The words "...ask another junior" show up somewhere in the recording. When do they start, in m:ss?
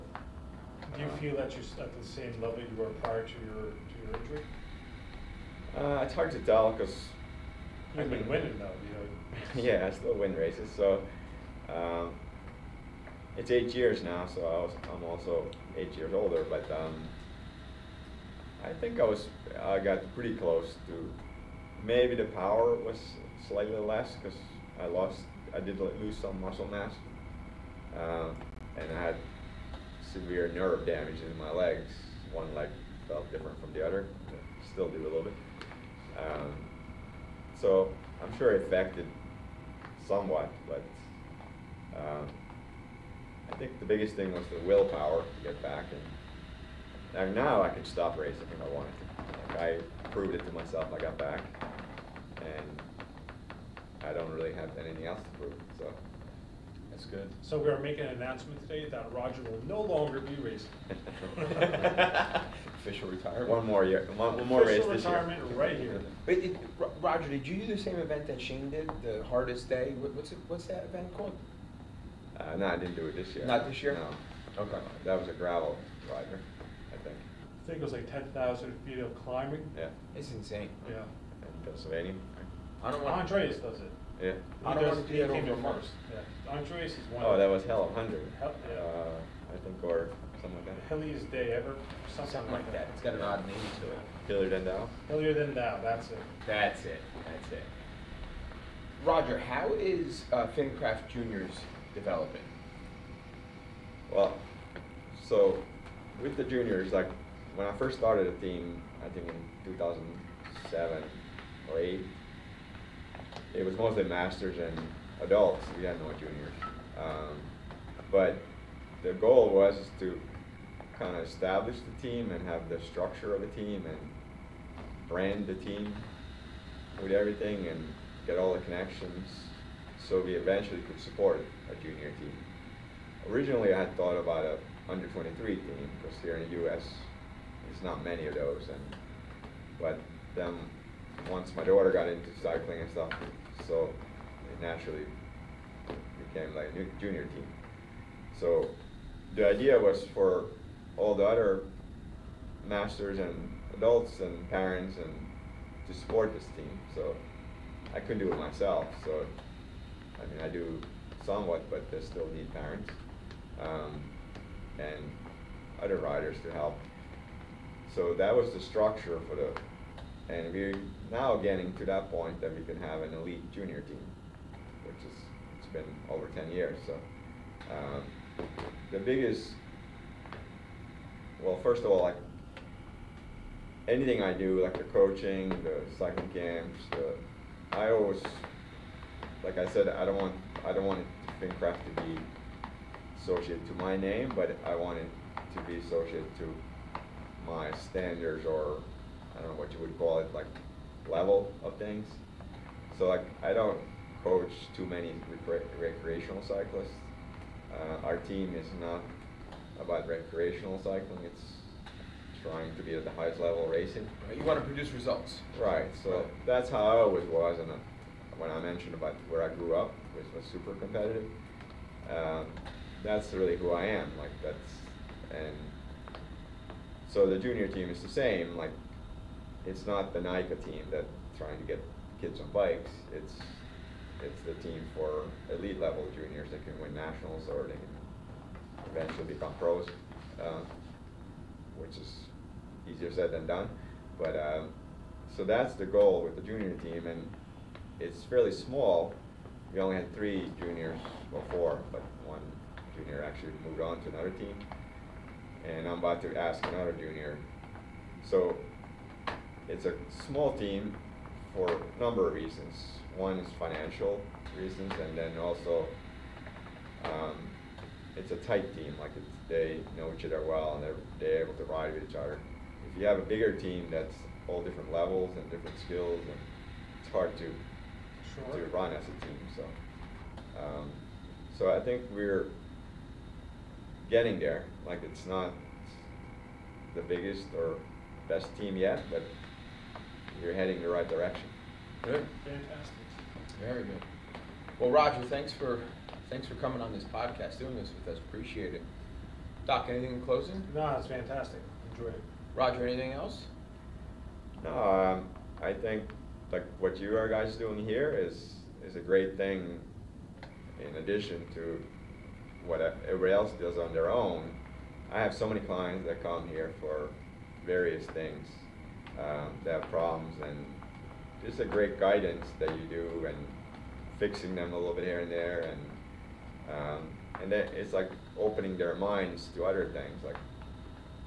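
4:16.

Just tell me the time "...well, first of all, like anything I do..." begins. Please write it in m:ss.
3:01.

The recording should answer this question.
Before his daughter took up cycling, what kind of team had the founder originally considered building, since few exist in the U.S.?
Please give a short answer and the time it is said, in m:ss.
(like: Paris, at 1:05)
Under 23 team, at 2:14.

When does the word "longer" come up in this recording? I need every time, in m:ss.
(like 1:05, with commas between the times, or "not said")
0:59.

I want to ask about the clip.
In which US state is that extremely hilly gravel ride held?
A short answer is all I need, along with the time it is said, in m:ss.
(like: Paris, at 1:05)
Pennsylvania, at 1:21.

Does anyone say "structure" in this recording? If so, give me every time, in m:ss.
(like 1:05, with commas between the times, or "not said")
2:02, 2:48.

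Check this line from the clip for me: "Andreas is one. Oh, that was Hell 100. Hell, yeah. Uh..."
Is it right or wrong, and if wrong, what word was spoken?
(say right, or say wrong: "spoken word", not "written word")
right.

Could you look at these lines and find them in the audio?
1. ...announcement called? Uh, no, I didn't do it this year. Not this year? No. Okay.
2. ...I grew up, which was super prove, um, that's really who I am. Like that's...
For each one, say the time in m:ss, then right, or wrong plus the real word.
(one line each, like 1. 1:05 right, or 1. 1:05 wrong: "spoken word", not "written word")
1. 1:10 wrong: "event", not "announcement"
2. 3:39 wrong: "competitive", not "prove".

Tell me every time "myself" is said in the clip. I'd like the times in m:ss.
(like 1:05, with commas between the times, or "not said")
0:50, 2:38.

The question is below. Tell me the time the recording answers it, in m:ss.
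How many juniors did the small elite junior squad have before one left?
4:10.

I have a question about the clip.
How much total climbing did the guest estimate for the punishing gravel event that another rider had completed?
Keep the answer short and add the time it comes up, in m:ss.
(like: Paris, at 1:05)
10,000 feet, at 1:18.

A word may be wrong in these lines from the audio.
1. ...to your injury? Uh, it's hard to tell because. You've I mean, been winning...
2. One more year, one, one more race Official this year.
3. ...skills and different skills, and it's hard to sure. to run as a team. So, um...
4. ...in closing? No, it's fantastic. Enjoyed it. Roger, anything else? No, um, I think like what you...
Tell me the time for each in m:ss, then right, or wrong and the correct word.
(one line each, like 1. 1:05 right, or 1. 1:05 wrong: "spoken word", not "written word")
1. 0:03 right
2. 1:03 right
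3. 4:34 wrong: "levels", not "skills"
4. 5:00 right.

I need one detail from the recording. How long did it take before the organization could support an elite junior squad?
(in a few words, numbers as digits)
Over 10 years.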